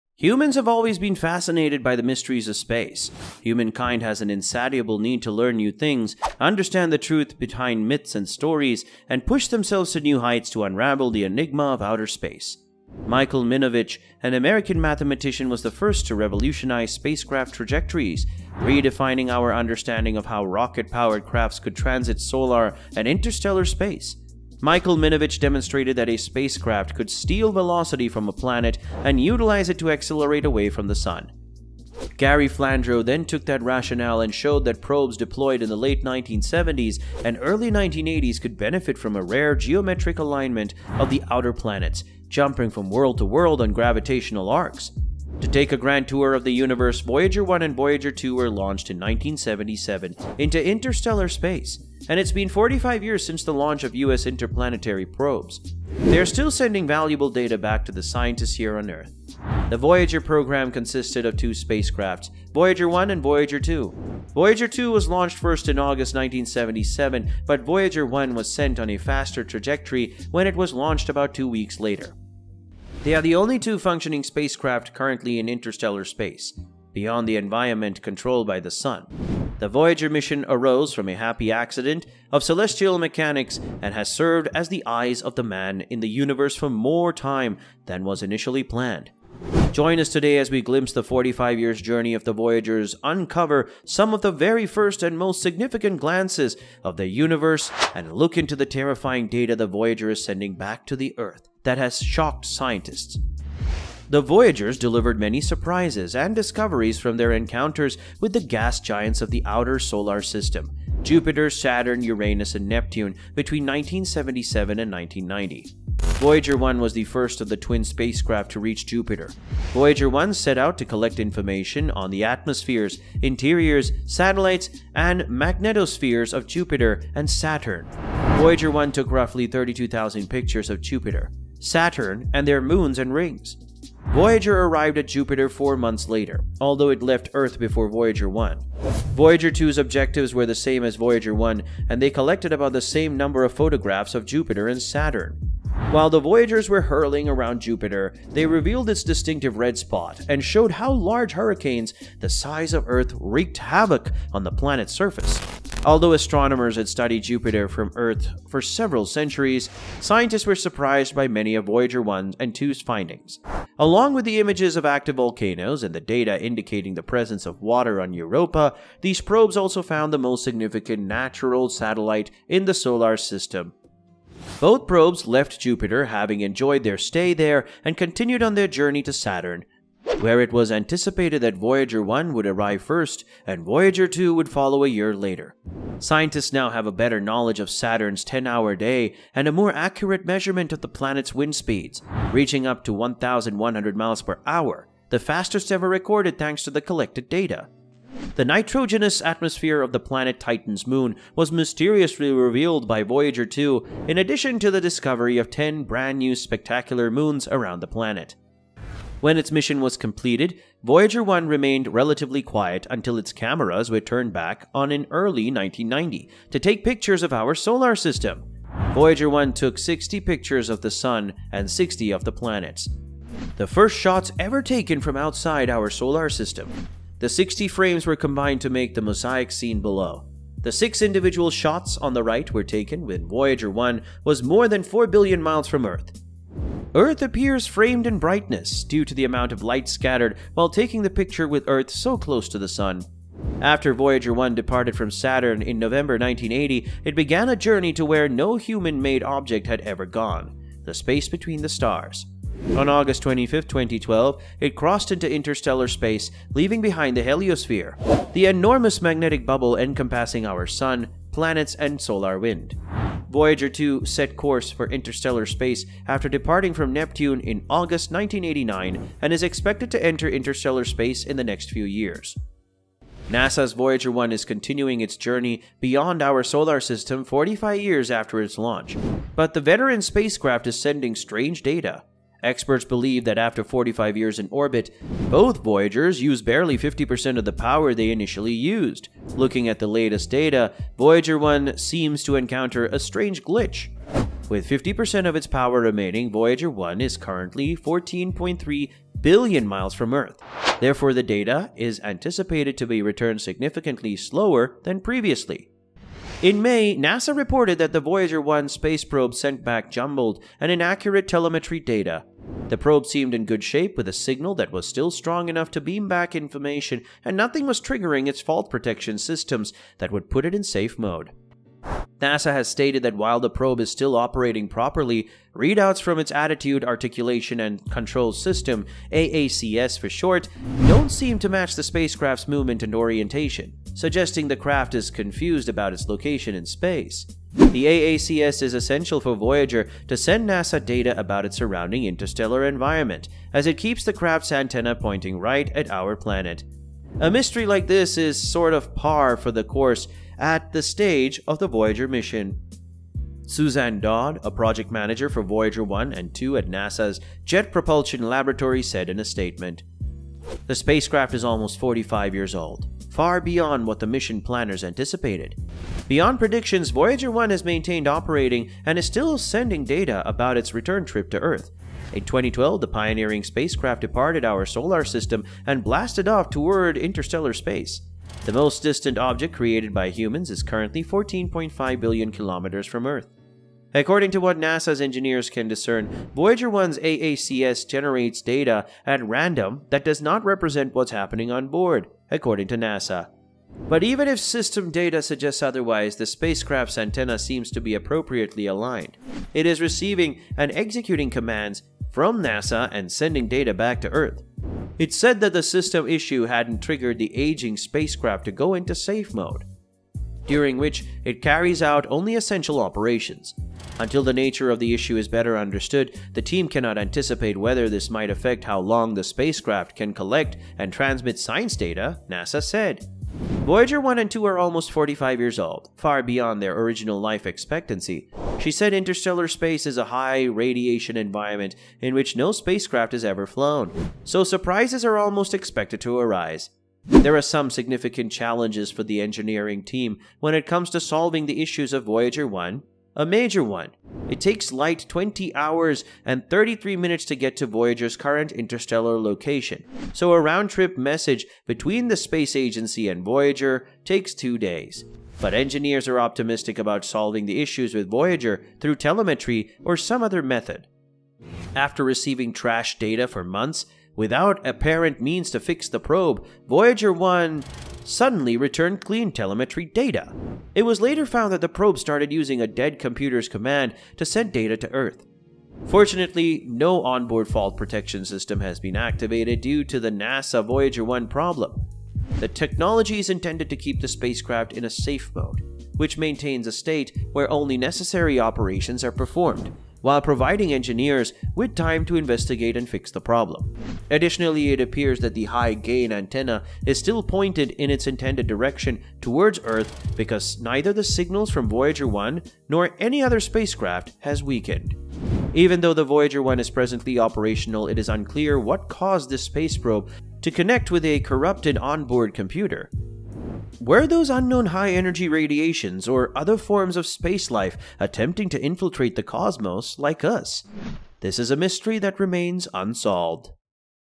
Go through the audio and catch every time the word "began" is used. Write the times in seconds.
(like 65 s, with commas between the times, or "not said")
247 s.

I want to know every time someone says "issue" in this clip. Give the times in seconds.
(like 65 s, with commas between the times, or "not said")
406 s, 414 s, 441 s, 457 s.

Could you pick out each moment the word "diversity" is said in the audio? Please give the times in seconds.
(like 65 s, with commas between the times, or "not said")
not said.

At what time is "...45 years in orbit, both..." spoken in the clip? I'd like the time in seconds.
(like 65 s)
283 s.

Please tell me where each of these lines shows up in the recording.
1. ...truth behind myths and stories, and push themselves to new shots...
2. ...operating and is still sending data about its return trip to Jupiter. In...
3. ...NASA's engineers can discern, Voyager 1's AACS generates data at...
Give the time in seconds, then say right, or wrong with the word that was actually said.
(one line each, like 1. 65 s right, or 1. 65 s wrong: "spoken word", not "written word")
1. 6 s wrong: "heights", not "shots"
2. 368 s wrong: "Earth", not "Jupiter"
3. 384 s right.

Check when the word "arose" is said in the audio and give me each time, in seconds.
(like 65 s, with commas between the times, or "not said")
80 s.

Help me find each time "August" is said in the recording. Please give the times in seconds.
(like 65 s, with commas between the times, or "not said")
65 s, 252 s, 267 s.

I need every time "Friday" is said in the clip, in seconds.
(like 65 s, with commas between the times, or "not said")
not said.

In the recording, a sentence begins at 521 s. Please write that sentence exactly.
This is a mystery that remains unsolved.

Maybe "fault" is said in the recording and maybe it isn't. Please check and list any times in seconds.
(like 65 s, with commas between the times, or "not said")
318 s, 477 s.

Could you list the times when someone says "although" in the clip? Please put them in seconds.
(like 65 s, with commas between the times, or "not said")
136 s, 155 s.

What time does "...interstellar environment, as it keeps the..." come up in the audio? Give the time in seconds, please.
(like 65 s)
342 s.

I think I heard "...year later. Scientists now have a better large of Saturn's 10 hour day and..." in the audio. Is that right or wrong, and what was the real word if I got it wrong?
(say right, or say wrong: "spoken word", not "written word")
wrong: "knowledge", not "large".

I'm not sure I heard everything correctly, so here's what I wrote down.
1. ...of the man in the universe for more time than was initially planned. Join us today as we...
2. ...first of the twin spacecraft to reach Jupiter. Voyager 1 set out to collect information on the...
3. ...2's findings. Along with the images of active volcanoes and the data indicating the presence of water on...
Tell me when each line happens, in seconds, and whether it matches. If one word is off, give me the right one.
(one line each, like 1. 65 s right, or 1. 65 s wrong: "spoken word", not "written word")
1. 85 s right
2. 117 s right
3. 162 s right.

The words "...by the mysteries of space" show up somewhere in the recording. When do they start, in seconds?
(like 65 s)
1 s.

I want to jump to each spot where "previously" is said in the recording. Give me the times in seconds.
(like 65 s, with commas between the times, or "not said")
304 s.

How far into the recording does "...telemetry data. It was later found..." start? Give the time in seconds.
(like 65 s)
469 s.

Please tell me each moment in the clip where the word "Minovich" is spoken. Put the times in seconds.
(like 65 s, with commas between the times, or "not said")
13 s, 24 s.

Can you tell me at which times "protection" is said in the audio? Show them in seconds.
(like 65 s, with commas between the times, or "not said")
318 s, 477 s.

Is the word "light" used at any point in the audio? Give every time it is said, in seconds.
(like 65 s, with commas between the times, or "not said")
239 s, 444 s.